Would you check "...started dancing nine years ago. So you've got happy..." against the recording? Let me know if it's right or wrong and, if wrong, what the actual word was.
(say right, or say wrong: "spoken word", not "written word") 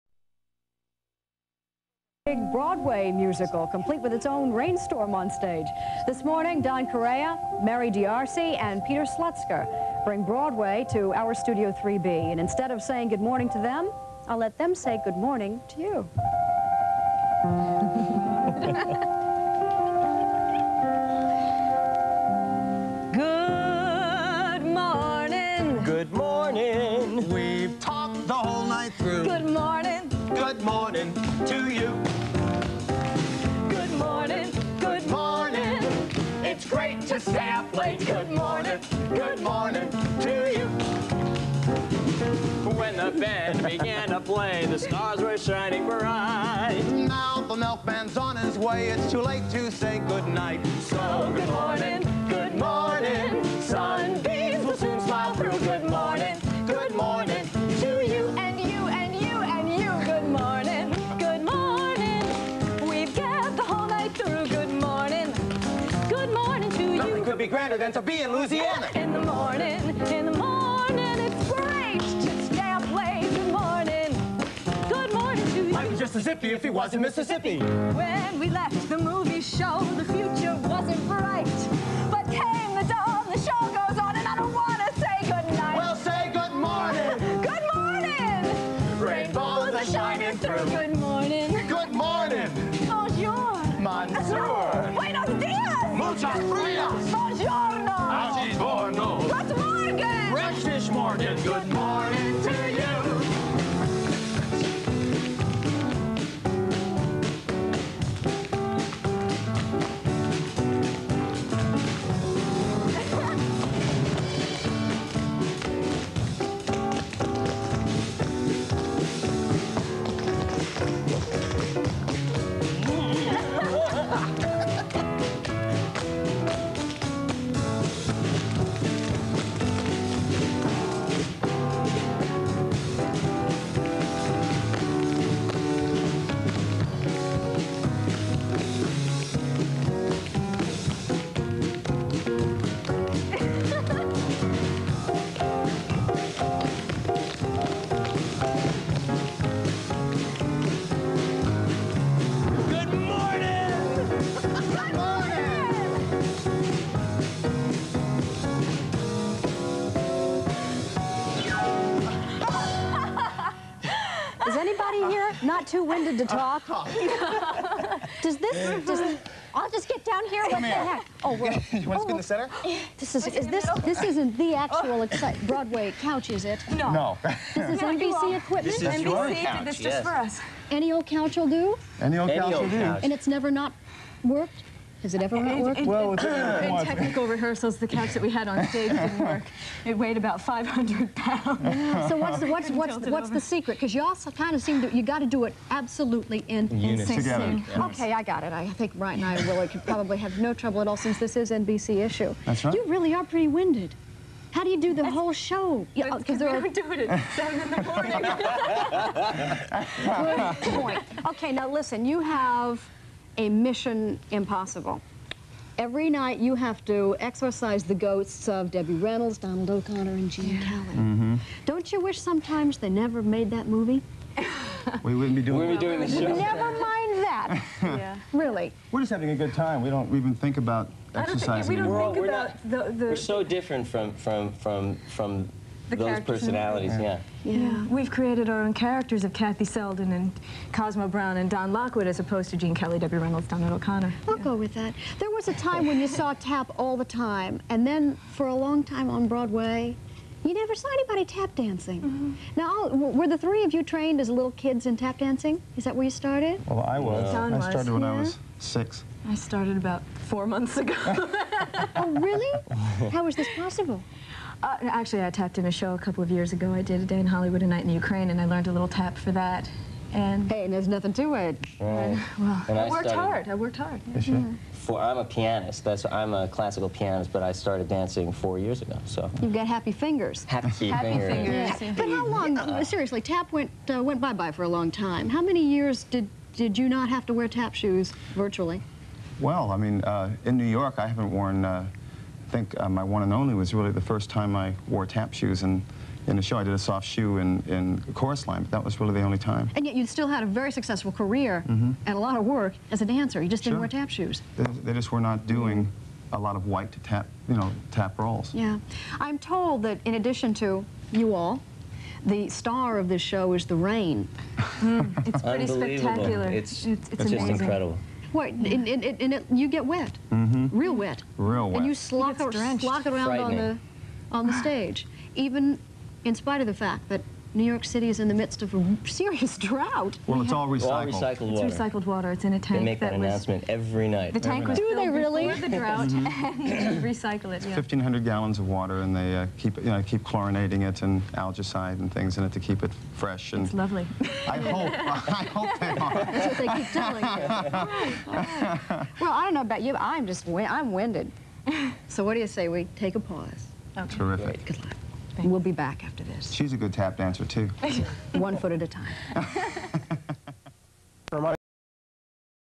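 wrong: "four", not "nine".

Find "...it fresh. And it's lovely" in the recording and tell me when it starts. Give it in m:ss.
5:42.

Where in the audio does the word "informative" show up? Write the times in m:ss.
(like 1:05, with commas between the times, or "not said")
not said.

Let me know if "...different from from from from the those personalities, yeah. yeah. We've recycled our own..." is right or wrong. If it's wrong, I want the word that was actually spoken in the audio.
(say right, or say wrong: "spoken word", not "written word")
wrong: "created", not "recycled".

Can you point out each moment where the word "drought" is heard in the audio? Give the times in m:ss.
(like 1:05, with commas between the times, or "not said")
5:29, 5:35.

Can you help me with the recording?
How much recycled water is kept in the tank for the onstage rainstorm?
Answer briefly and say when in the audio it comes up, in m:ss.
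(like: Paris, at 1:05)
1,500 gallons, at 5:37.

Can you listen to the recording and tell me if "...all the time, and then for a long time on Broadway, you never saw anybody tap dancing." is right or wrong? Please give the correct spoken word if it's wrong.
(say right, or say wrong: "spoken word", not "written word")
right.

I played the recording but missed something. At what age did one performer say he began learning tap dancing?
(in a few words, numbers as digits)
6.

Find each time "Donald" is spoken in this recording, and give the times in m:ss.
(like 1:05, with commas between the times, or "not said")
3:39, 4:03.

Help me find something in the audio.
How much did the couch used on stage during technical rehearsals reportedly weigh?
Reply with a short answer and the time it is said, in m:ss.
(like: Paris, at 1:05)
500 pounds, at 3:10.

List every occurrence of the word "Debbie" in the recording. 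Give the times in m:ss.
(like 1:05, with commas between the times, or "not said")
3:38, 4:02.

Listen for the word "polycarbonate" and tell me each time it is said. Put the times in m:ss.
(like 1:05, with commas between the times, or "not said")
not said.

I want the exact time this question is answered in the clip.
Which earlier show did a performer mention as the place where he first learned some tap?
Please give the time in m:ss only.
4:27.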